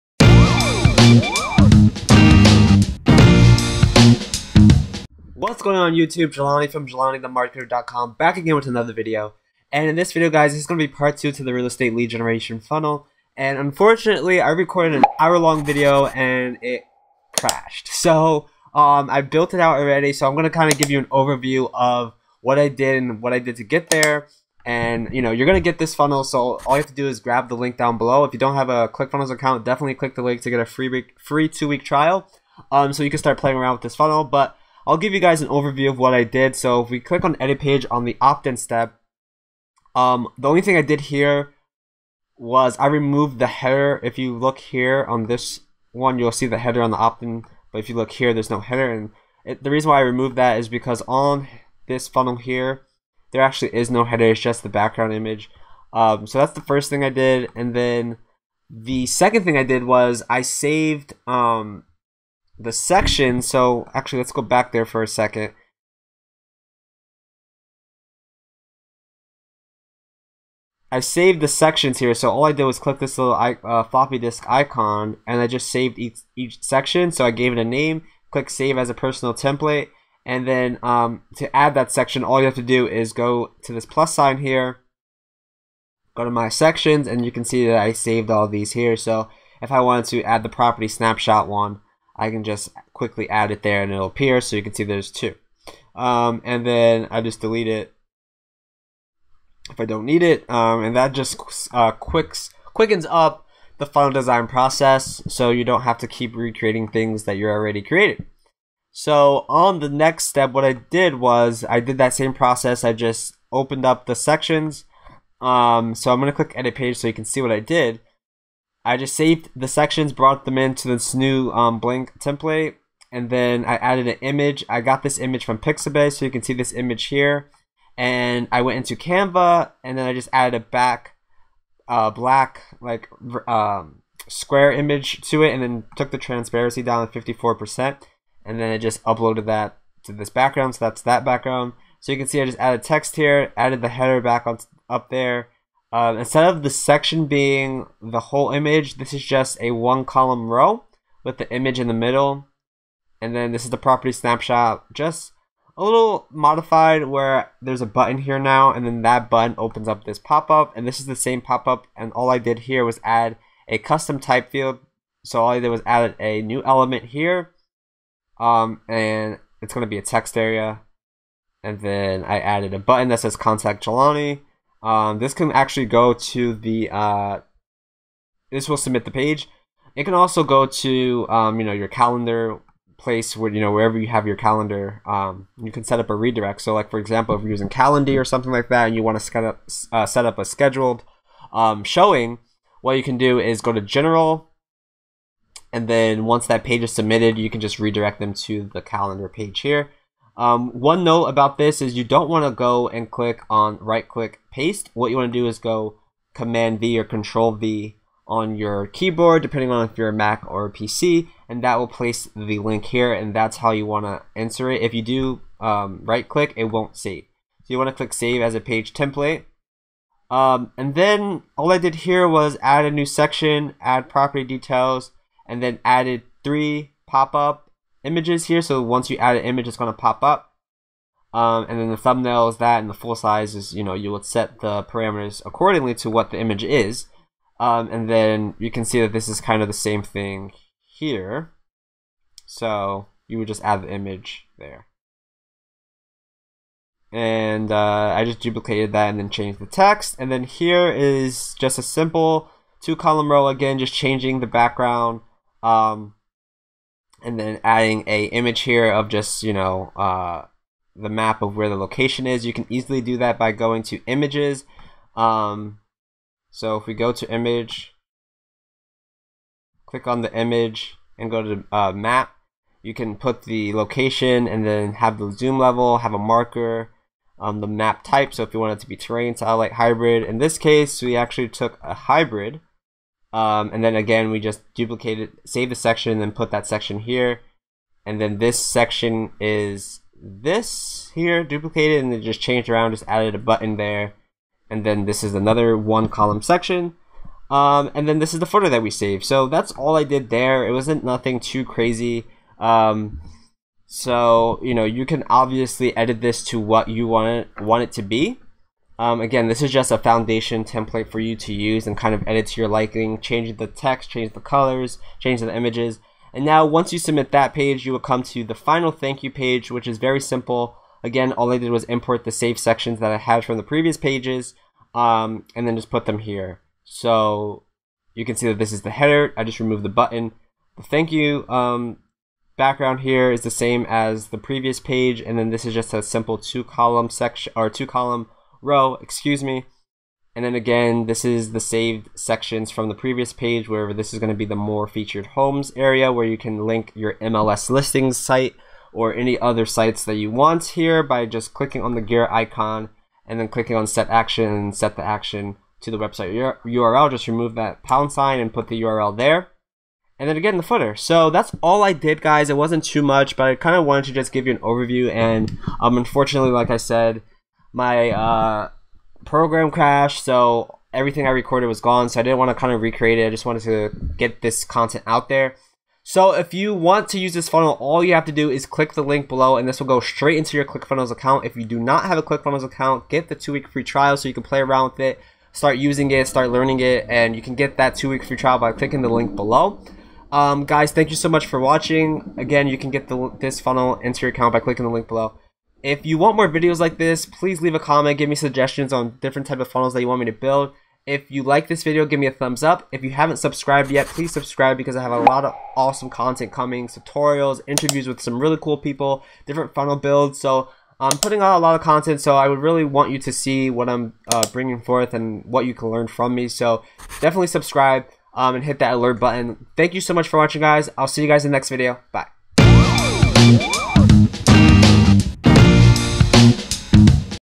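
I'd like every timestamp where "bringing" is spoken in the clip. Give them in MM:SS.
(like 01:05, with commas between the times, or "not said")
06:54.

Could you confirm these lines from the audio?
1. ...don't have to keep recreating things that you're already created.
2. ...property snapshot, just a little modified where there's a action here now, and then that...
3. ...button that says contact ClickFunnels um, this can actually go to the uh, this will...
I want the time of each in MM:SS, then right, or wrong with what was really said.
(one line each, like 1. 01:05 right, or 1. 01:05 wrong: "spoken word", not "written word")
1. 01:45 right
2. 02:33 wrong: "button", not "action"
3. 02:52 wrong: "Jelani", not "ClickFunnels".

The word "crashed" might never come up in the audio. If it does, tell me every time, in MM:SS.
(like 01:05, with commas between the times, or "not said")
00:17, 06:09.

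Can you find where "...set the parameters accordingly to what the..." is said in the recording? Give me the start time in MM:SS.
03:54.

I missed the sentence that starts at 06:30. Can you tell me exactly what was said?
Um, guys, thank you so much for watching.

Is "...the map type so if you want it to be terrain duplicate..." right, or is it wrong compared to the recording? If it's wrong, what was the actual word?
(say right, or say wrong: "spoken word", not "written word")
wrong: "satellite", not "duplicate".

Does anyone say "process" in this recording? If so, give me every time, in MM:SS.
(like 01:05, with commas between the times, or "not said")
01:44, 01:52.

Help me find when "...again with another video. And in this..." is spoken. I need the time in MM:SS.
00:08.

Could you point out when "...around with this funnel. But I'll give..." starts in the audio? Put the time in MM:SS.
00:33.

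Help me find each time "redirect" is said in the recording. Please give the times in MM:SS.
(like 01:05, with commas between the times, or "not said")
03:06, 03:17.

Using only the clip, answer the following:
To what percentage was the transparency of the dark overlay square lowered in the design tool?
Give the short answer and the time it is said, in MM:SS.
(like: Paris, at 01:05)
54%, at 02:17.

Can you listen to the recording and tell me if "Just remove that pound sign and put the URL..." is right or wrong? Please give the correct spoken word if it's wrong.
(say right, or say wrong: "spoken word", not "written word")
right.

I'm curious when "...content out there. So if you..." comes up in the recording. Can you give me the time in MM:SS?
06:14.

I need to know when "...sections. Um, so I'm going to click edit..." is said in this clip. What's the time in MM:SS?
01:54.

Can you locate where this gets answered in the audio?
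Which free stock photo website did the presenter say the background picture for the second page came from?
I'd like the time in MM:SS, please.
02:05.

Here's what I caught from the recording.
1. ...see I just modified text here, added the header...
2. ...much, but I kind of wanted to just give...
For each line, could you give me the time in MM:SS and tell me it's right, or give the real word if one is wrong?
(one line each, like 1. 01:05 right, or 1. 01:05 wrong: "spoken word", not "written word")
1. 02:22 wrong: "added", not "modified"
2. 06:03 right.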